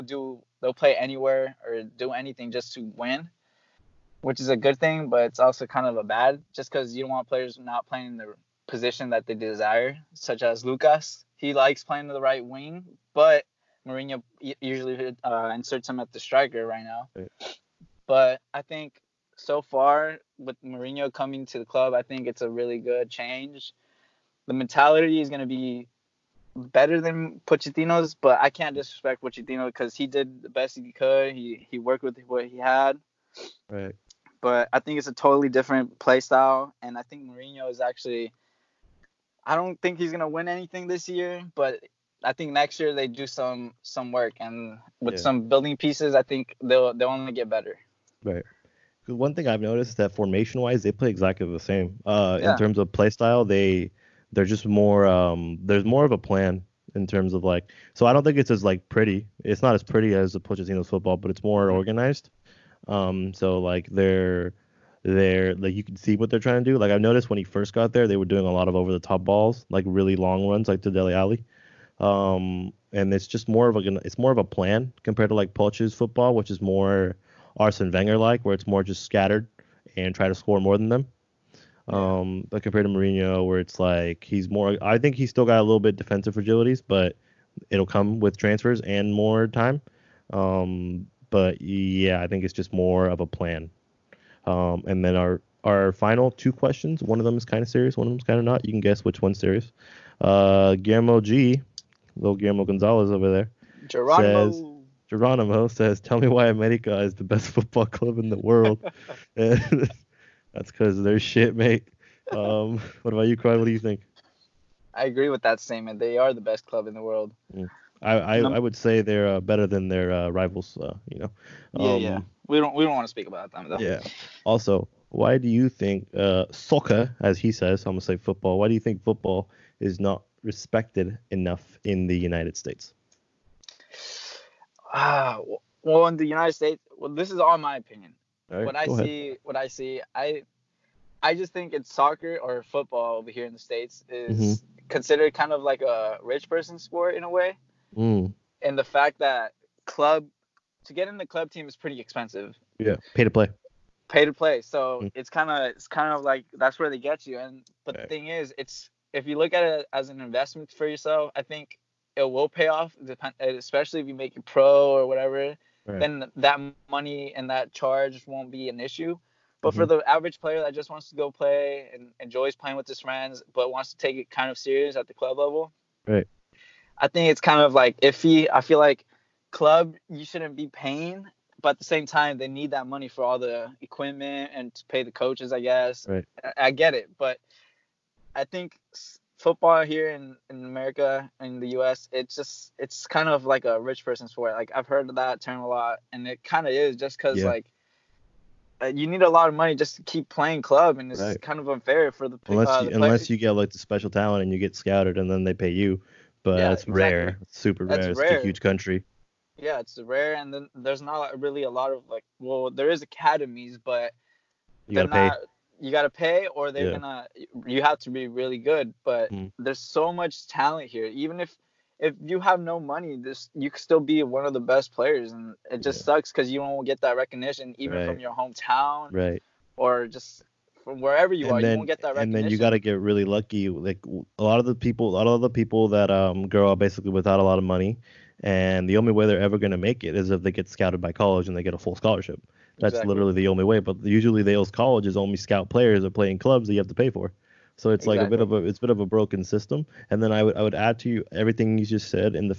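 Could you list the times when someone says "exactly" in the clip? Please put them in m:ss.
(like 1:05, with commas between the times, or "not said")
0:51, 3:26, 4:02, 4:08.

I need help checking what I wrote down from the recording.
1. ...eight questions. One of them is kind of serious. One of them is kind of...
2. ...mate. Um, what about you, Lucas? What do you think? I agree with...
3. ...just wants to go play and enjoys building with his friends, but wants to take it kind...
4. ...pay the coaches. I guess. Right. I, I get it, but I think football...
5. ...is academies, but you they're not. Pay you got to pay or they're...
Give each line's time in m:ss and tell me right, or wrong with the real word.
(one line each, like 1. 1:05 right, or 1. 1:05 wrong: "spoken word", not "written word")
1. 1:36 wrong: "two", not "eight"
2. 1:51 wrong: "Crod", not "Lucas"
3. 2:50 wrong: "playing", not "building"
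4. 3:04 right
5. 3:32 right.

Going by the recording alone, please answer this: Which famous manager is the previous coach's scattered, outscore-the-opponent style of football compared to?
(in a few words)
Arsene Wenger.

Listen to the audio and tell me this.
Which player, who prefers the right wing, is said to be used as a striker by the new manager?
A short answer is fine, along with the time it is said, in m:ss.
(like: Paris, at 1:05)
Lucas, at 0:10.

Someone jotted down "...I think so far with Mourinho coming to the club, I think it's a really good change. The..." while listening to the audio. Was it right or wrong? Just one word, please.
right.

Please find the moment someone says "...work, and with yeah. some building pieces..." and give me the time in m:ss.
0:44.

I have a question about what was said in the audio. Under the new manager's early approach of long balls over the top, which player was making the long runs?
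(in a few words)
Dele Alli.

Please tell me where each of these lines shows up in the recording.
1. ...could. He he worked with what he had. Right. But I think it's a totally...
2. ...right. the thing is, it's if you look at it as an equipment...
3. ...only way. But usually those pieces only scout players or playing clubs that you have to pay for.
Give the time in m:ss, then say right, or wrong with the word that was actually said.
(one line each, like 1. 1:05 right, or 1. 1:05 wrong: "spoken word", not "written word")
1. 0:30 right
2. 2:37 wrong: "investment", not "equipment"
3. 4:03 wrong: "colleges", not "pieces".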